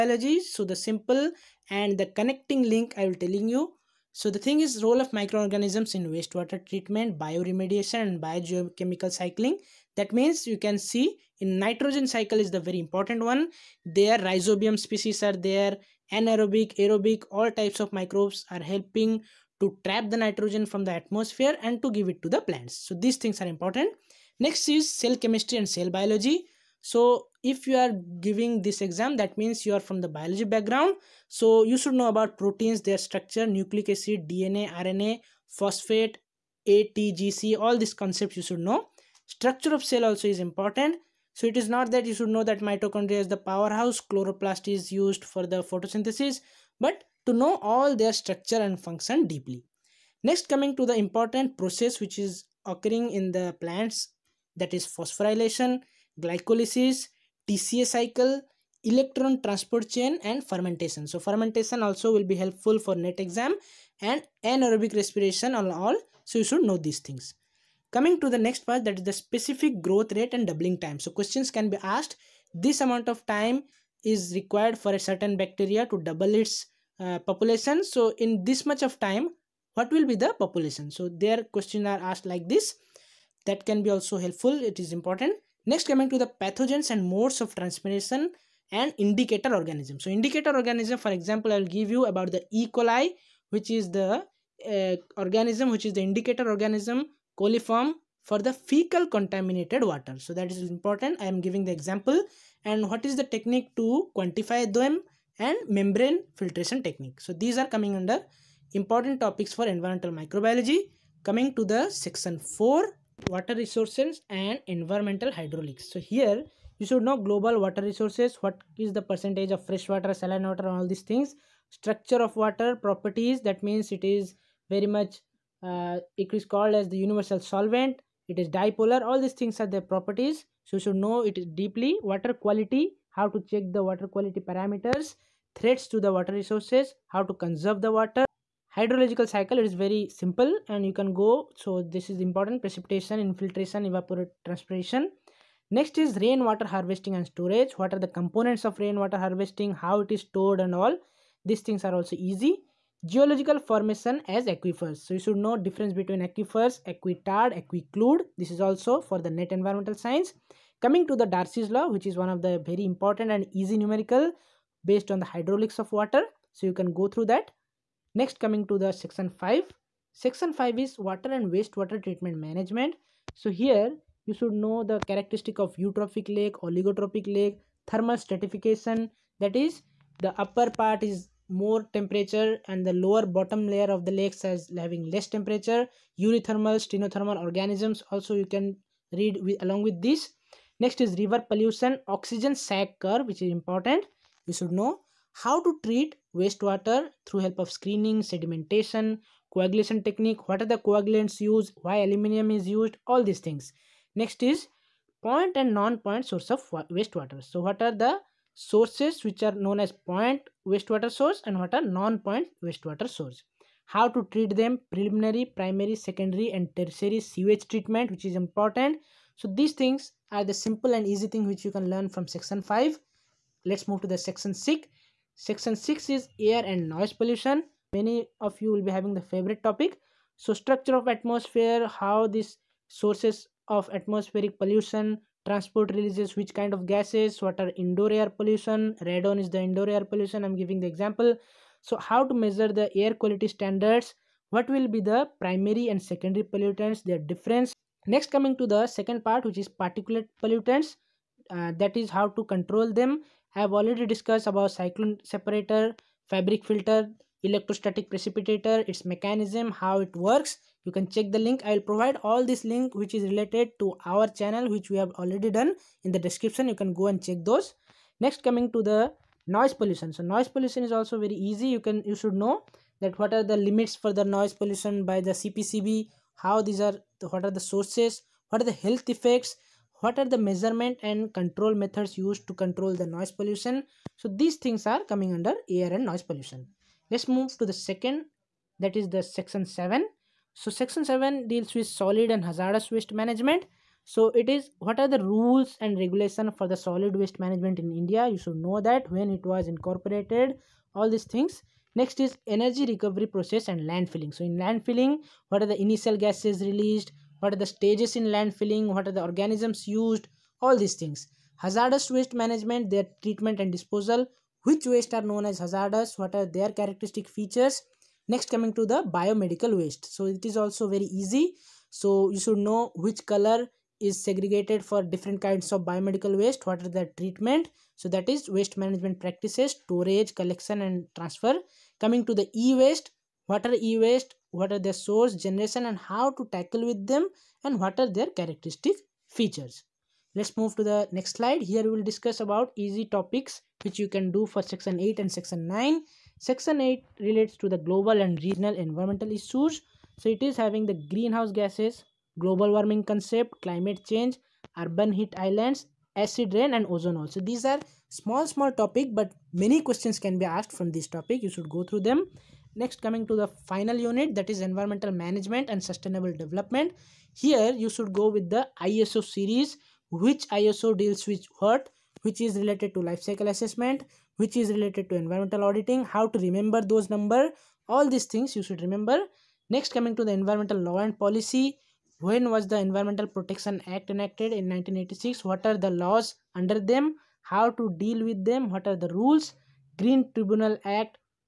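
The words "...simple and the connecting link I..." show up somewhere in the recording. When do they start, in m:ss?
0:00.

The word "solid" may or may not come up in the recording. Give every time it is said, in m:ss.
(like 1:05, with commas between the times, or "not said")
4:51, 4:56.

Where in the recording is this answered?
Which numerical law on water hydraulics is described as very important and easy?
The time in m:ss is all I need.
2:41.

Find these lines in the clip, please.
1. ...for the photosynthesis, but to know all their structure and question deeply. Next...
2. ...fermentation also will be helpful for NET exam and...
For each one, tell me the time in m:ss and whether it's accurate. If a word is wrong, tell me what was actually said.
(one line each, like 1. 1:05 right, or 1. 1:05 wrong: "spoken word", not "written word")
1. 0:45 wrong: "function", not "question"
2. 1:01 right.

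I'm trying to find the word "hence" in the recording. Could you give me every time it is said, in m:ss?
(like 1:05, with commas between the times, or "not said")
not said.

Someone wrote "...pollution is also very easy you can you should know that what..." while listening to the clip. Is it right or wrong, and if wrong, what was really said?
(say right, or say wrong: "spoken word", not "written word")
right.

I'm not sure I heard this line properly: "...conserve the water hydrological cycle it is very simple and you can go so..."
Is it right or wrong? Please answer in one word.
right.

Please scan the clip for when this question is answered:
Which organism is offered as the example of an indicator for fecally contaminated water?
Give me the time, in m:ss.
1:32.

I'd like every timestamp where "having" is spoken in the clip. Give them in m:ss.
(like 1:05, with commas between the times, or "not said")
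3:04, 3:48, 5:50.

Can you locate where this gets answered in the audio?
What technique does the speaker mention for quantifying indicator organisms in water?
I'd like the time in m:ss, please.
1:45.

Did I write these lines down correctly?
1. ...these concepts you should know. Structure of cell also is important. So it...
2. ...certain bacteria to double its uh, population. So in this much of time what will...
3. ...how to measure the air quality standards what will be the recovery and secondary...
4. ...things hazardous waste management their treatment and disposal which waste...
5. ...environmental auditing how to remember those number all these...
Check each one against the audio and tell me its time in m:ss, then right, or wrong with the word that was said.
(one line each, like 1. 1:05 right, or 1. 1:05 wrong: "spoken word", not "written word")
1. 0:37 right
2. 1:14 right
3. 4:02 wrong: "primary", not "recovery"
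4. 5:11 right
5. 6:15 right.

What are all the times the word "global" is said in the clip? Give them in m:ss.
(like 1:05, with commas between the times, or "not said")
1:57, 5:47, 5:52.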